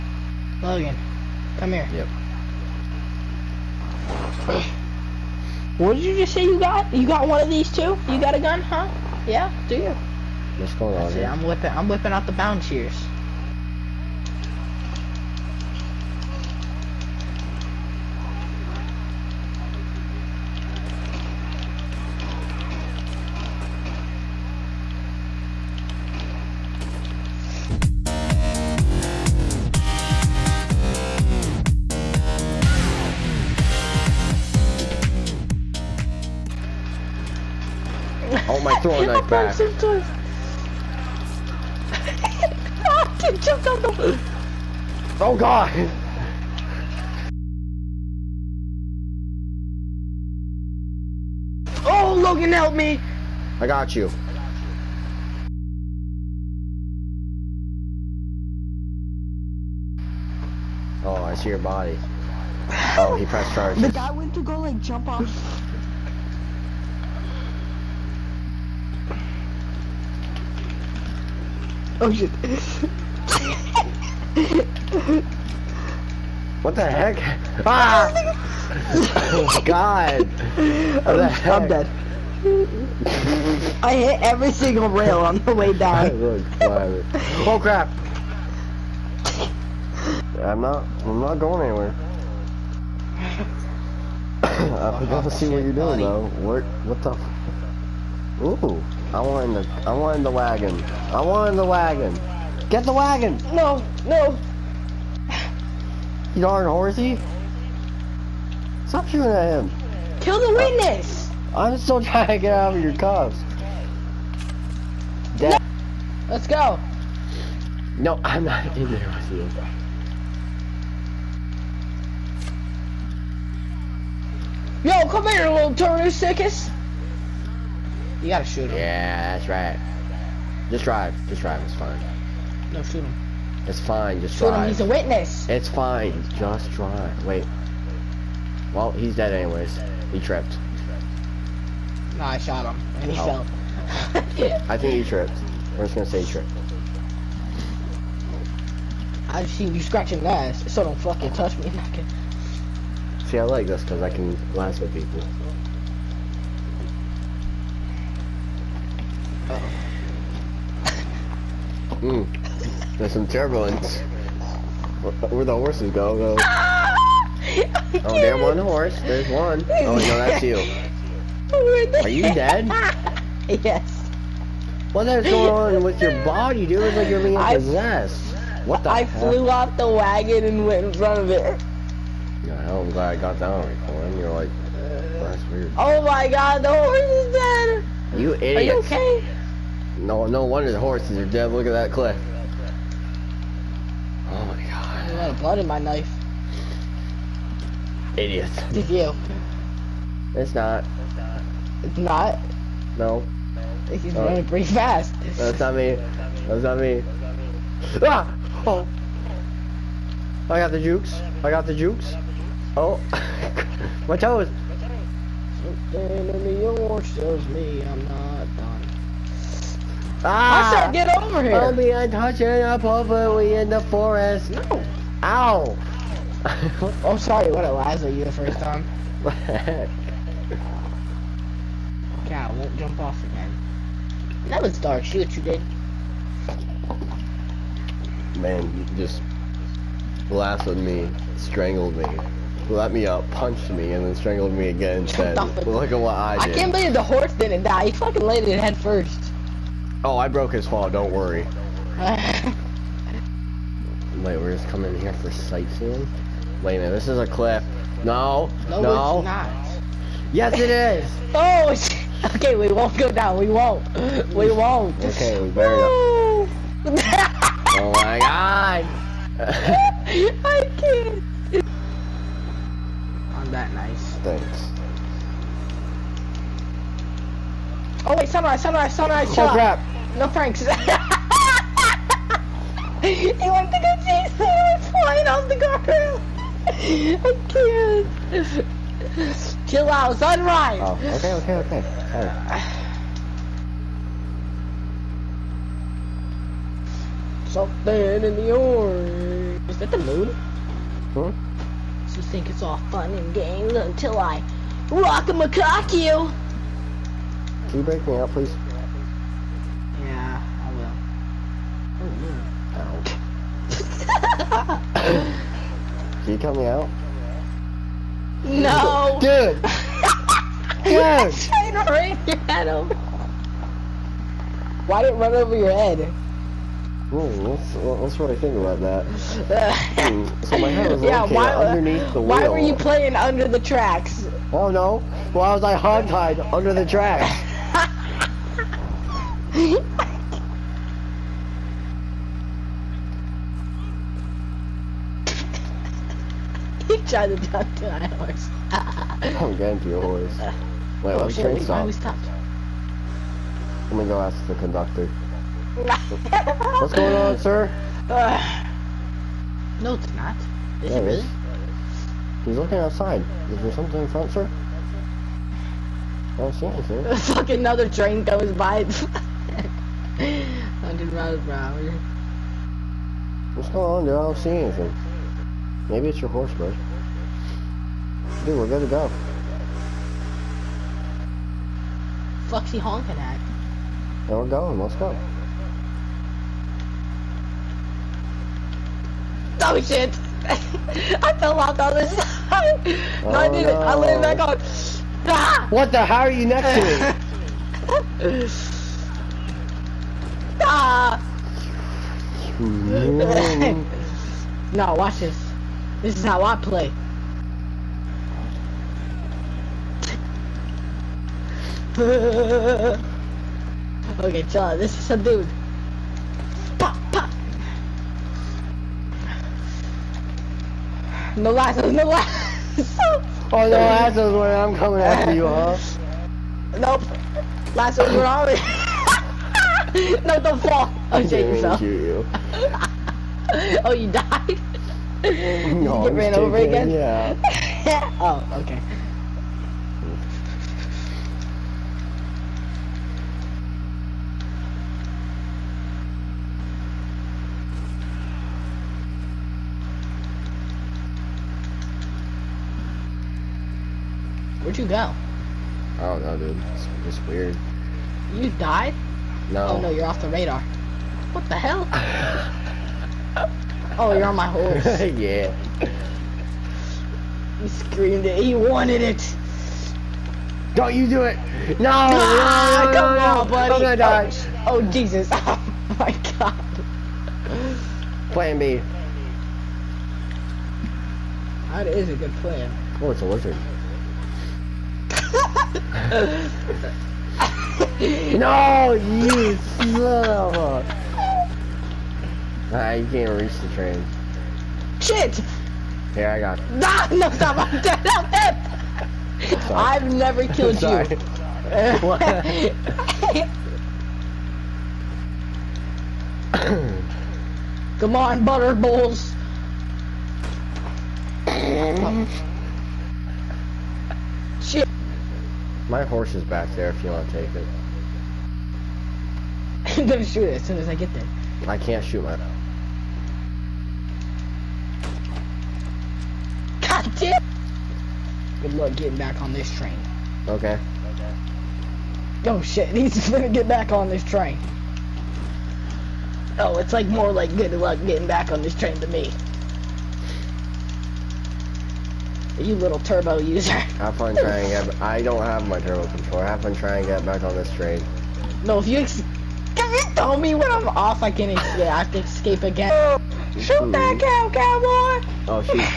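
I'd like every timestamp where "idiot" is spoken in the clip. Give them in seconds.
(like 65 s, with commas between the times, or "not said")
188 s, 198 s.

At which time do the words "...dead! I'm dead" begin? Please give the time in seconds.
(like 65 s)
497 s.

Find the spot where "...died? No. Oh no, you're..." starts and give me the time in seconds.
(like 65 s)
458 s.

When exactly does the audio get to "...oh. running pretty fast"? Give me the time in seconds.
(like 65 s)
204 s.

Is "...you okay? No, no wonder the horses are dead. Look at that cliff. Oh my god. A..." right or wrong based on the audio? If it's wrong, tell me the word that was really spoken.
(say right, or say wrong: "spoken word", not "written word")
right.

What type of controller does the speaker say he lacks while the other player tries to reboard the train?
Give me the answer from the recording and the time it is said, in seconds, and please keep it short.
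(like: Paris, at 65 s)
turbo controller, at 545 s.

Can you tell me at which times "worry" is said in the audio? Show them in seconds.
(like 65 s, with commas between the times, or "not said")
251 s.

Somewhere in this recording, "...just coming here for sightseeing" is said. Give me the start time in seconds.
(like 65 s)
254 s.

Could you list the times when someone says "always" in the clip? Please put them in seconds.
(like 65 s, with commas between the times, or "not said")
428 s.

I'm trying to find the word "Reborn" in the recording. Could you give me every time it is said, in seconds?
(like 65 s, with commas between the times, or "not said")
not said.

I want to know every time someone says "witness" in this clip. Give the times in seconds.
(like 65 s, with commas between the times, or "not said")
110 s, 134 s.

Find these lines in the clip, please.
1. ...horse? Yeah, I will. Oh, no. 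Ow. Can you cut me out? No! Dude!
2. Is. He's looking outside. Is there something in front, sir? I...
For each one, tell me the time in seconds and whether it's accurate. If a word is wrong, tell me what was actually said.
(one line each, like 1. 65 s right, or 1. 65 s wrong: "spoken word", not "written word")
1. 308 s wrong: "please", not "horse"
2. 361 s right.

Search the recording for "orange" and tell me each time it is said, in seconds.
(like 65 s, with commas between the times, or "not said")
216 s, 298 s.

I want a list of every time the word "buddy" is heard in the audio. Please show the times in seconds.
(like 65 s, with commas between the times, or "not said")
96 s, 473 s.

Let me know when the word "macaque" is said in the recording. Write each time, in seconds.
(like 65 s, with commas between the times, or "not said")
305 s.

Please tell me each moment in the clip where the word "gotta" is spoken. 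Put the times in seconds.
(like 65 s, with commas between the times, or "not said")
95 s, 128 s.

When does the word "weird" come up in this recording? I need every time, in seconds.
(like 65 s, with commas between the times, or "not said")
185 s, 457 s.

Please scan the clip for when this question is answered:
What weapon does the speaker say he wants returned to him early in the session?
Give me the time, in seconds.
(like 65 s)
38 s.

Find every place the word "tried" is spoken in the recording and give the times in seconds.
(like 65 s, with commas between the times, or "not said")
347 s.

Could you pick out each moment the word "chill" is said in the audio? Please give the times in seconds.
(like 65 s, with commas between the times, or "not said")
279 s, 289 s, 414 s.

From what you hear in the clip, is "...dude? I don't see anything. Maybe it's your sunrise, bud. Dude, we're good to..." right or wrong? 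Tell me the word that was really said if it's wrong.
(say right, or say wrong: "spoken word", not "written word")
wrong: "horse", not "sunrise".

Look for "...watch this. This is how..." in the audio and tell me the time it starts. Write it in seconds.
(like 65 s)
404 s.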